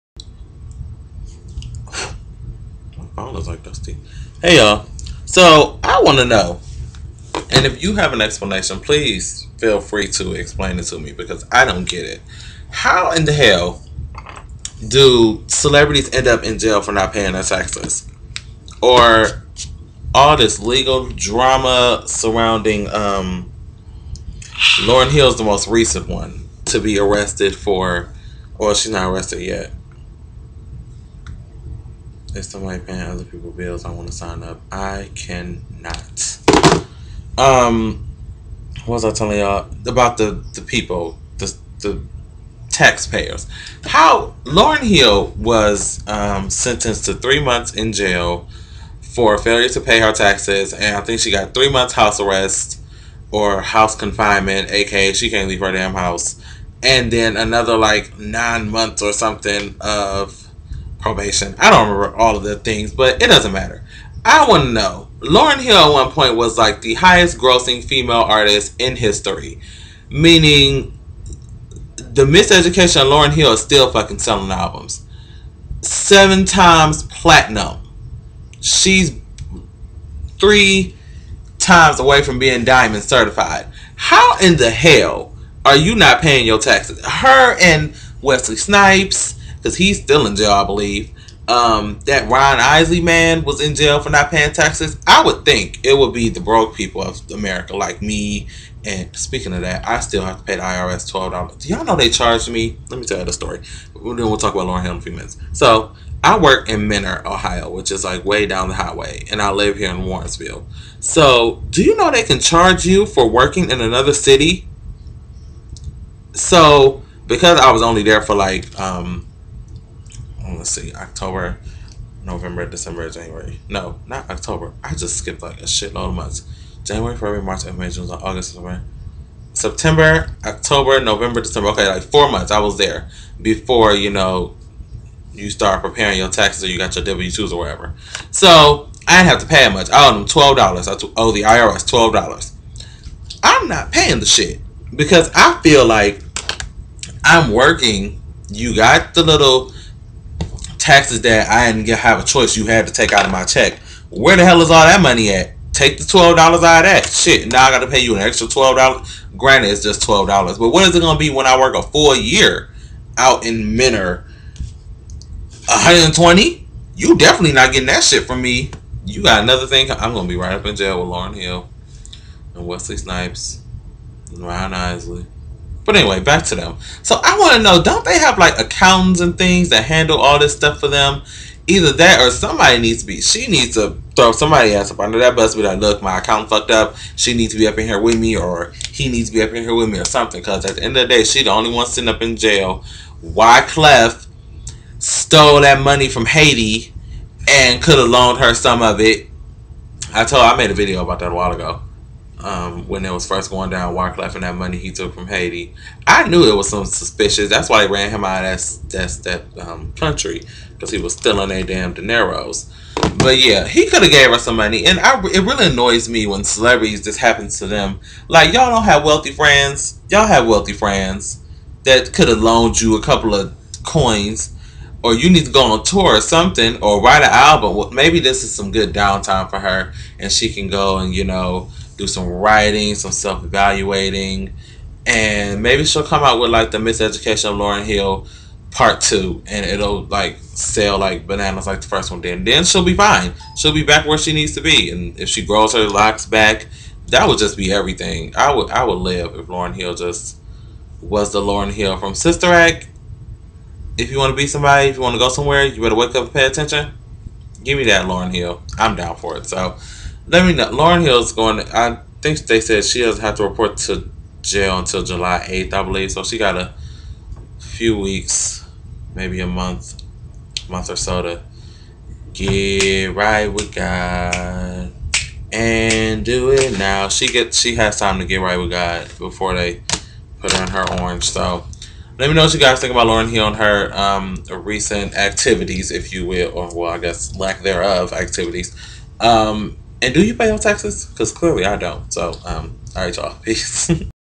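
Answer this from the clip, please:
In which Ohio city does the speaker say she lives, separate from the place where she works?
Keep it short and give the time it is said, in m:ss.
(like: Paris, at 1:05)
Warrensville, at 1:50.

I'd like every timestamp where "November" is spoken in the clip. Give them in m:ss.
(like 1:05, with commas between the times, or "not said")
2:02, 2:11.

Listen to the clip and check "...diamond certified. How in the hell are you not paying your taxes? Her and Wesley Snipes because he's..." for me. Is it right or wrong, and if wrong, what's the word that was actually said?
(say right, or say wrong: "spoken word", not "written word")
right.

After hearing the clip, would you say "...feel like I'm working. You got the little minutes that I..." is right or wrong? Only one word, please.
wrong.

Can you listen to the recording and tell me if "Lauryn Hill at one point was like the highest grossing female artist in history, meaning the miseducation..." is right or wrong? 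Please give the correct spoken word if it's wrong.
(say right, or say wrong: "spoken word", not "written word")
right.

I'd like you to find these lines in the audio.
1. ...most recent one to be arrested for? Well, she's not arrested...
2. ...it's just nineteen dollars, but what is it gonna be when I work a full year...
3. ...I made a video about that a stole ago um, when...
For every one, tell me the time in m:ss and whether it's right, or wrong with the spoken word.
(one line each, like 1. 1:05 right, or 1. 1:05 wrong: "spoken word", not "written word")
1. 0:25 right
2. 2:39 wrong: "twelve", not "nineteen"
3. 3:20 wrong: "while", not "stole".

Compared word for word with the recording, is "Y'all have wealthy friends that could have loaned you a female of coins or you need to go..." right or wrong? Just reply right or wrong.
wrong.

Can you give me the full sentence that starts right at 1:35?
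I would think it would be the broke people of America, like me.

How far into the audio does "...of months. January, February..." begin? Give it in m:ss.
2:06.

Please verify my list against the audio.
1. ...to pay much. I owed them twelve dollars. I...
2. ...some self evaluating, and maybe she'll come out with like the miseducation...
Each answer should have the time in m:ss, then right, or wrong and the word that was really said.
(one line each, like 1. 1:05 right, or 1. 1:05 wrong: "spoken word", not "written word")
1. 2:19 right
2. 3:52 right.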